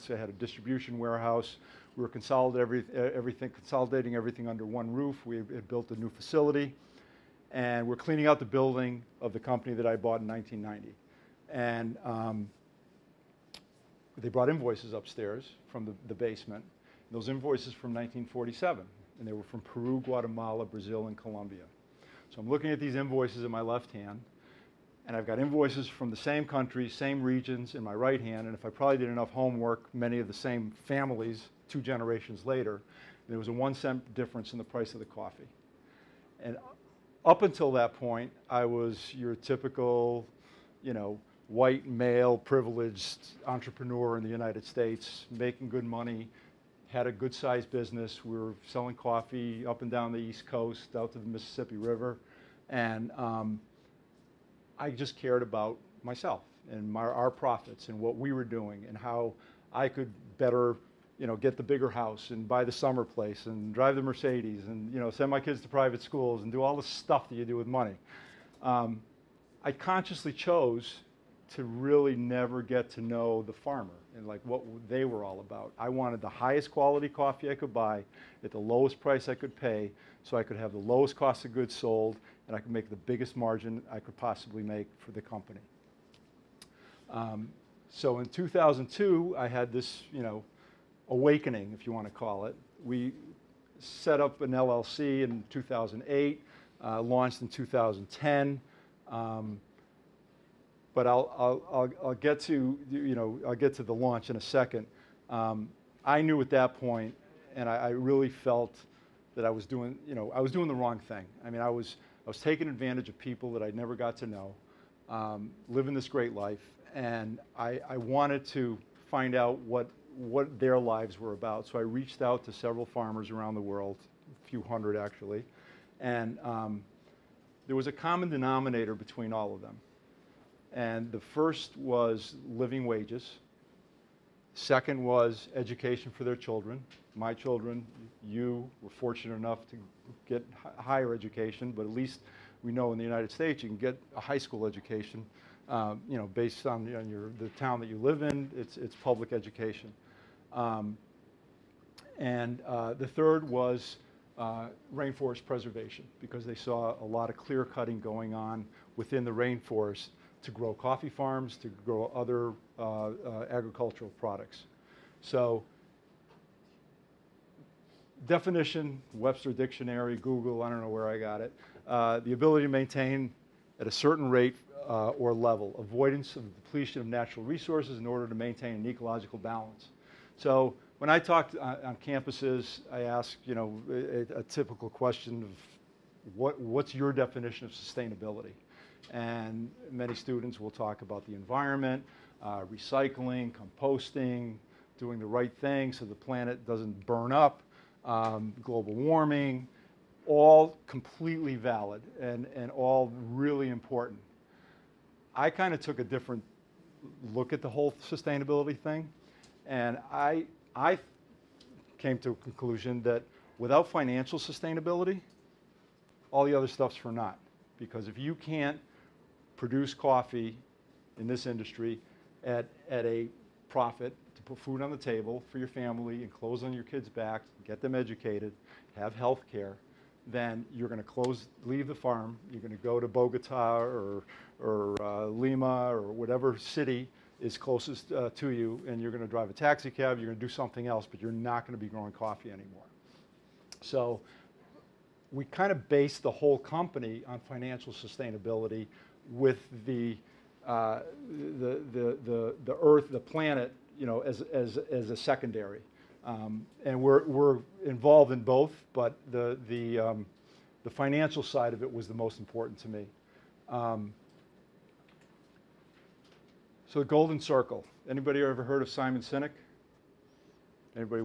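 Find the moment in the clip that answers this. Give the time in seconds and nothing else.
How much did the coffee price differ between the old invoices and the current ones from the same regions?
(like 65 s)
33 s.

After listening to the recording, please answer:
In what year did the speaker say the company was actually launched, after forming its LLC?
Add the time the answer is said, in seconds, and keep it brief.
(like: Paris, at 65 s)
2010, at 97 s.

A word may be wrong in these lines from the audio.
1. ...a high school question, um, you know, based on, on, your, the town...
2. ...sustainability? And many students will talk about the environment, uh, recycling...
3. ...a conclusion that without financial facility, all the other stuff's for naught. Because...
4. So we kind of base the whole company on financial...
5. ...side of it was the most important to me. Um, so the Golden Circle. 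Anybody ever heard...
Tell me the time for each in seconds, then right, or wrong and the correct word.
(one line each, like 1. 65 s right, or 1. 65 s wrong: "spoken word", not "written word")
1. 144 s wrong: "education", not "question"
2. 187 s right
3. 212 s wrong: "sustainability", not "facility"
4. 243 s right
5. 261 s right.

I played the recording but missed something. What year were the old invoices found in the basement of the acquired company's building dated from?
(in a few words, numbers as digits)
1947.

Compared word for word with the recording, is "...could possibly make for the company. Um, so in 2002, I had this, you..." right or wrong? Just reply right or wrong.
right.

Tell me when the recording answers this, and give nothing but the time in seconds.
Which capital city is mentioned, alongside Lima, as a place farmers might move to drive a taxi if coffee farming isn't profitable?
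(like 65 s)
233 s.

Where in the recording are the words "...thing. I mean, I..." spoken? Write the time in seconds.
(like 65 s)
110 s.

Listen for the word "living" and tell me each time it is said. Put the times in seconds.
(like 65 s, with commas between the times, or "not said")
115 s, 132 s.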